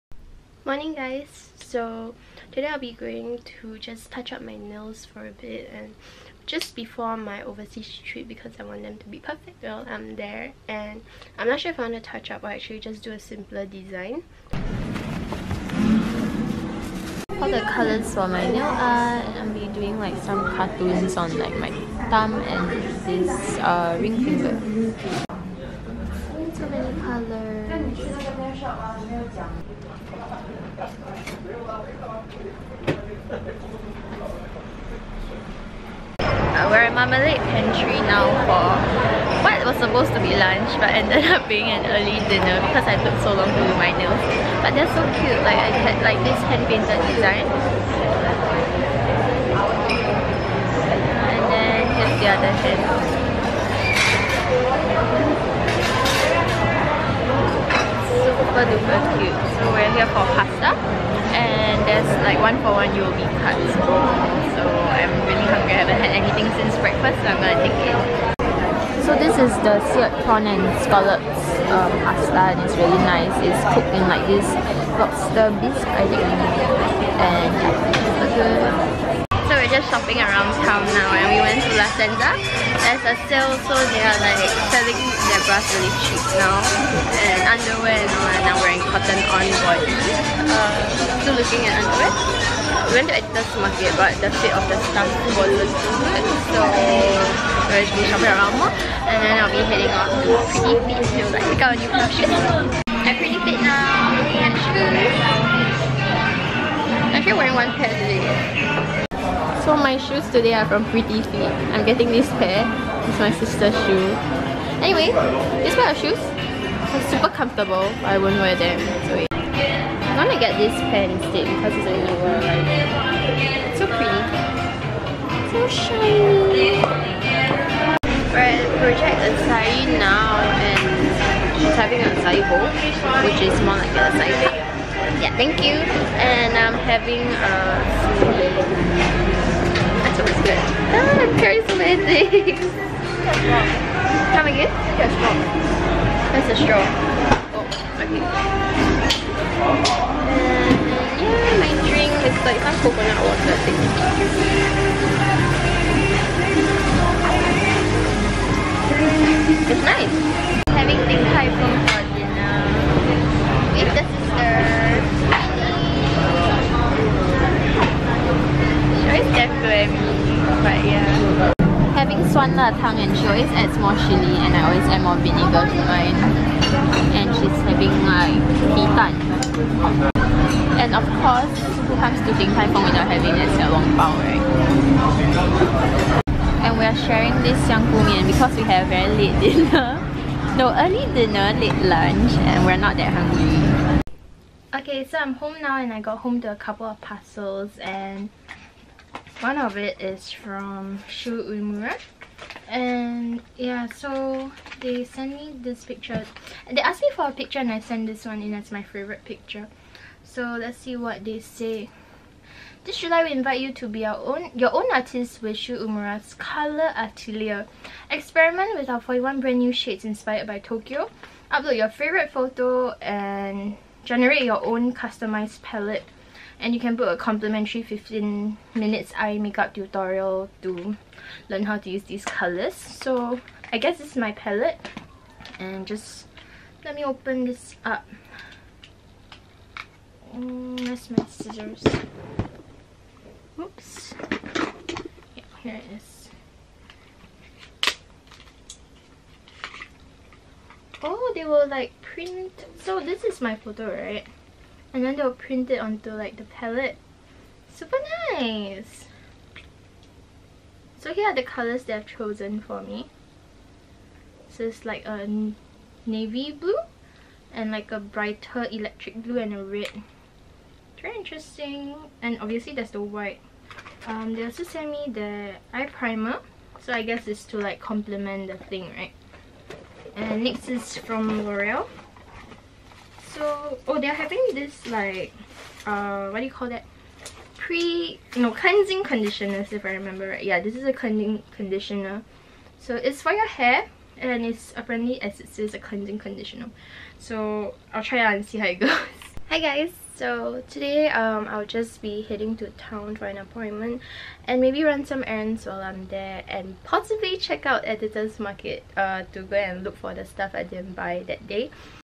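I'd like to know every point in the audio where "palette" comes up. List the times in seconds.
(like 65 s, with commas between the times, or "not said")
225 s, 234 s, 256 s.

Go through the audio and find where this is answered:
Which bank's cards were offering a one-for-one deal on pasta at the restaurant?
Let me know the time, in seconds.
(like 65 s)
62 s.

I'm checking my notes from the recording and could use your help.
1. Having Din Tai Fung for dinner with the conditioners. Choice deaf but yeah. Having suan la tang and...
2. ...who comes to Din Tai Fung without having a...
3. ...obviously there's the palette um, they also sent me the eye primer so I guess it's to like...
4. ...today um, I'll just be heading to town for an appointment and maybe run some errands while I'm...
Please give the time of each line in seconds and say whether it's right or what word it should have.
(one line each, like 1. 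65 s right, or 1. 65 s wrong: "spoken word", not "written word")
1. 160 s wrong: "sisters", not "conditioners"
2. 181 s right
3. 272 s wrong: "white", not "palette"
4. 300 s right.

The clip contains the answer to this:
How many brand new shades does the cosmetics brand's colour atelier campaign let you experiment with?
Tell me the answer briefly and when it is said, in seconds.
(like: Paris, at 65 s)
41, at 218 s.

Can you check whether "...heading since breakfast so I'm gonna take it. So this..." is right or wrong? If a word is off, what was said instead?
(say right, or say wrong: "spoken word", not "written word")
wrong: "anything", not "heading".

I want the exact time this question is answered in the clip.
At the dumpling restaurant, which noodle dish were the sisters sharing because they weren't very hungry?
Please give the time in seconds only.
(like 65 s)
187 s.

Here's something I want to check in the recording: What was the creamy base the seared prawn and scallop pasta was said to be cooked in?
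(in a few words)
lobster bisque.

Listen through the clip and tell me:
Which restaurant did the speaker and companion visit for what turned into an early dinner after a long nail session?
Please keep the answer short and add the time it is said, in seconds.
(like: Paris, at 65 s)
Marmalade Pantry, at 36 s.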